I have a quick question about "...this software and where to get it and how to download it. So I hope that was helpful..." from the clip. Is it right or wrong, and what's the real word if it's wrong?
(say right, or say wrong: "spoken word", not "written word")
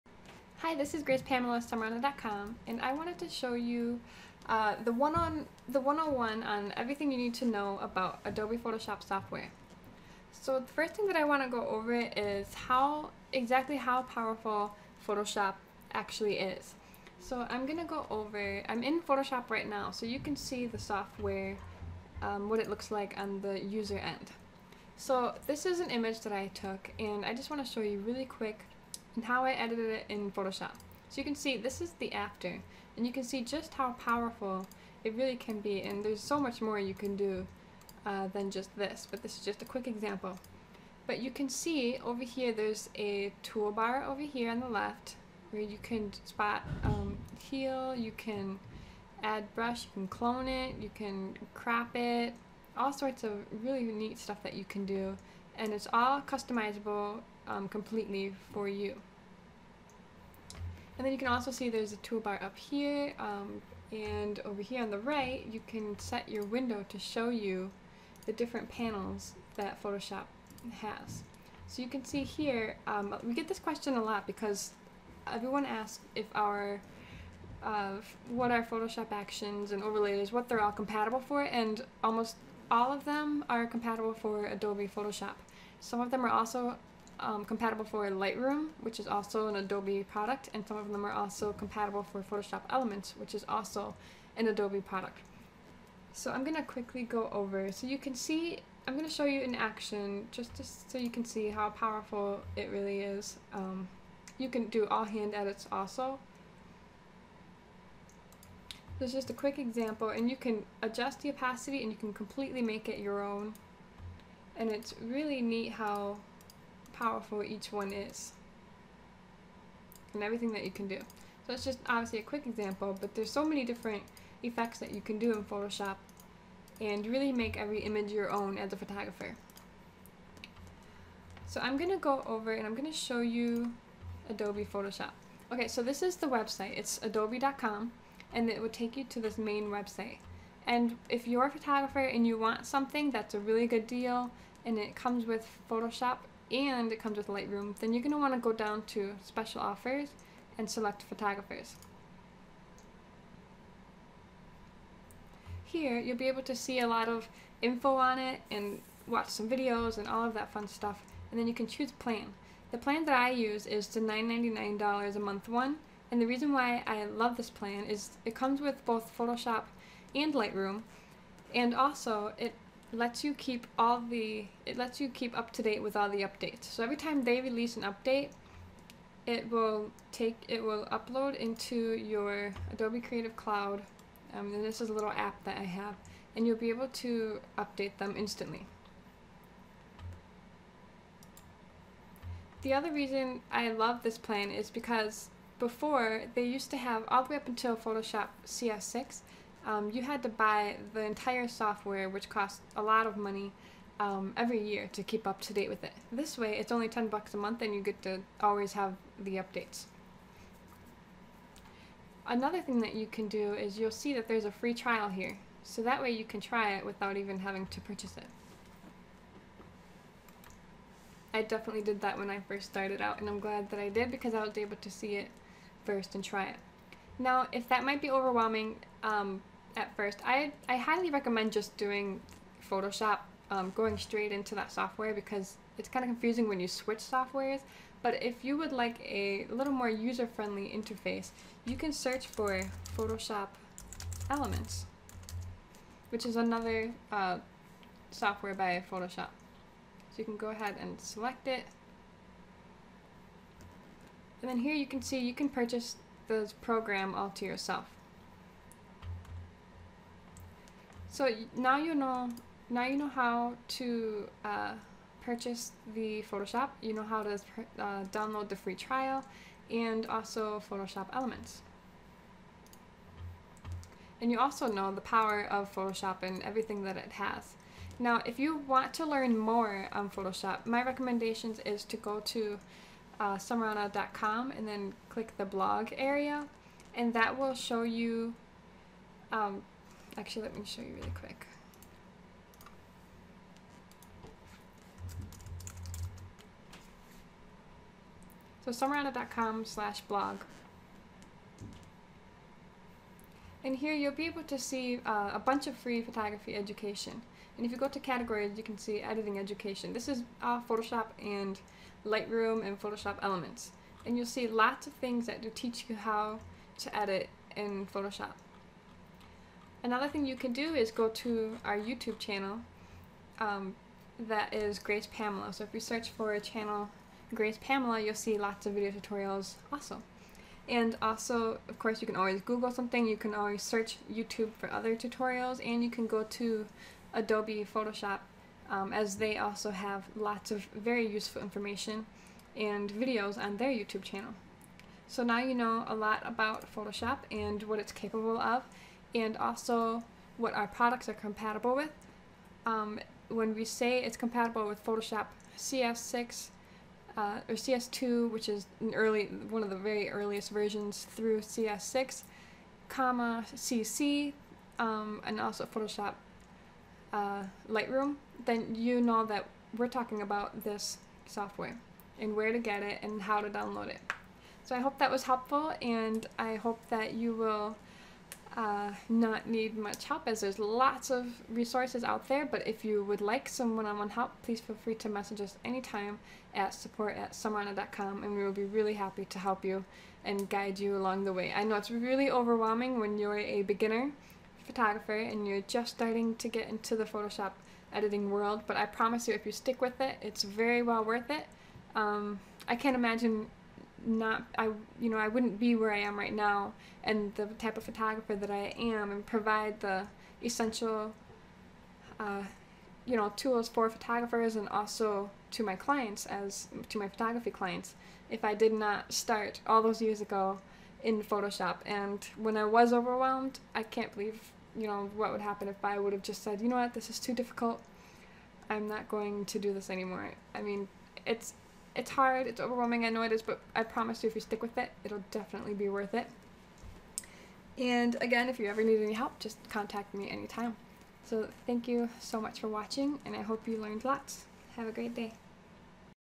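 right.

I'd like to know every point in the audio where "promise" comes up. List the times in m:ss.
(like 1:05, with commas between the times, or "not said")
6:38, 7:13.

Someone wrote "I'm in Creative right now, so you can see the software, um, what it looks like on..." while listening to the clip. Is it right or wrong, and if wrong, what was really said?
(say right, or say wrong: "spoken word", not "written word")
wrong: "Photoshop", not "Creative".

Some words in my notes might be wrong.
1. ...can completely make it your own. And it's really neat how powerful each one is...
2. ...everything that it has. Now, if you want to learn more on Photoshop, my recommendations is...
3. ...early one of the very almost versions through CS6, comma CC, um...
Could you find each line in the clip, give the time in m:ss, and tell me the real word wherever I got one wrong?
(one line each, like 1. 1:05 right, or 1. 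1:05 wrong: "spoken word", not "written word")
1. 1:51 right
2. 4:36 right
3. 5:58 wrong: "earliest", not "almost".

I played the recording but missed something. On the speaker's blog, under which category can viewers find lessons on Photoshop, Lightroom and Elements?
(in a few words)
editing education.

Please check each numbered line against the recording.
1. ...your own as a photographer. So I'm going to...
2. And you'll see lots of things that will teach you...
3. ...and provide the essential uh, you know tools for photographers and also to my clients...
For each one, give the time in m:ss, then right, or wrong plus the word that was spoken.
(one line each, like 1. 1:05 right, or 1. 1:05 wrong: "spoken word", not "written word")
1. 2:08 right
2. 5:14 right
3. 6:49 right.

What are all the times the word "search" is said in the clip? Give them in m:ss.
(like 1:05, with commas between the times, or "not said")
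4:01, 5:25, 5:33.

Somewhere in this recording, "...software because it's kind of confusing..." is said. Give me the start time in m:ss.
3:54.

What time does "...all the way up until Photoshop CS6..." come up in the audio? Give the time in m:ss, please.
3:17.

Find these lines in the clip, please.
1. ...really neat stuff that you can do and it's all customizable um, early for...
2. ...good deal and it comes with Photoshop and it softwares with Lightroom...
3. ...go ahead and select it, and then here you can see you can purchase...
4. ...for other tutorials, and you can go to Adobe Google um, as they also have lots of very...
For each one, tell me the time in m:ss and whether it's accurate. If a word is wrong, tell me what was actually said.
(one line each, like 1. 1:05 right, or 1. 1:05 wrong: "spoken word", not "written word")
1. 0:53 wrong: "completely", not "early"
2. 2:23 wrong: "comes", not "softwares"
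3. 4:10 right
4. 5:34 wrong: "Photoshop", not "Google".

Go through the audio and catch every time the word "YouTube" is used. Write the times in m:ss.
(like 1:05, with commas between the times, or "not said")
5:21, 5:34, 5:43.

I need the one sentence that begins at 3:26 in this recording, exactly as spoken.
This way, it's only 10 bucks a month and you get to always have the updates.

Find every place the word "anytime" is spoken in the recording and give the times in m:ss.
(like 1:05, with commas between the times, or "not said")
6:25, 7:20.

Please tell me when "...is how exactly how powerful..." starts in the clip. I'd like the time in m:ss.
0:11.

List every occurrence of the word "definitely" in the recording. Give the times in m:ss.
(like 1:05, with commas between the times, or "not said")
3:41, 7:15.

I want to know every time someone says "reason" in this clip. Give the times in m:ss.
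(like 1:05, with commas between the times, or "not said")
2:46, 3:12.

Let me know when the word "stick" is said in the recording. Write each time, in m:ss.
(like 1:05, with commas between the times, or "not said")
6:39, 7:14.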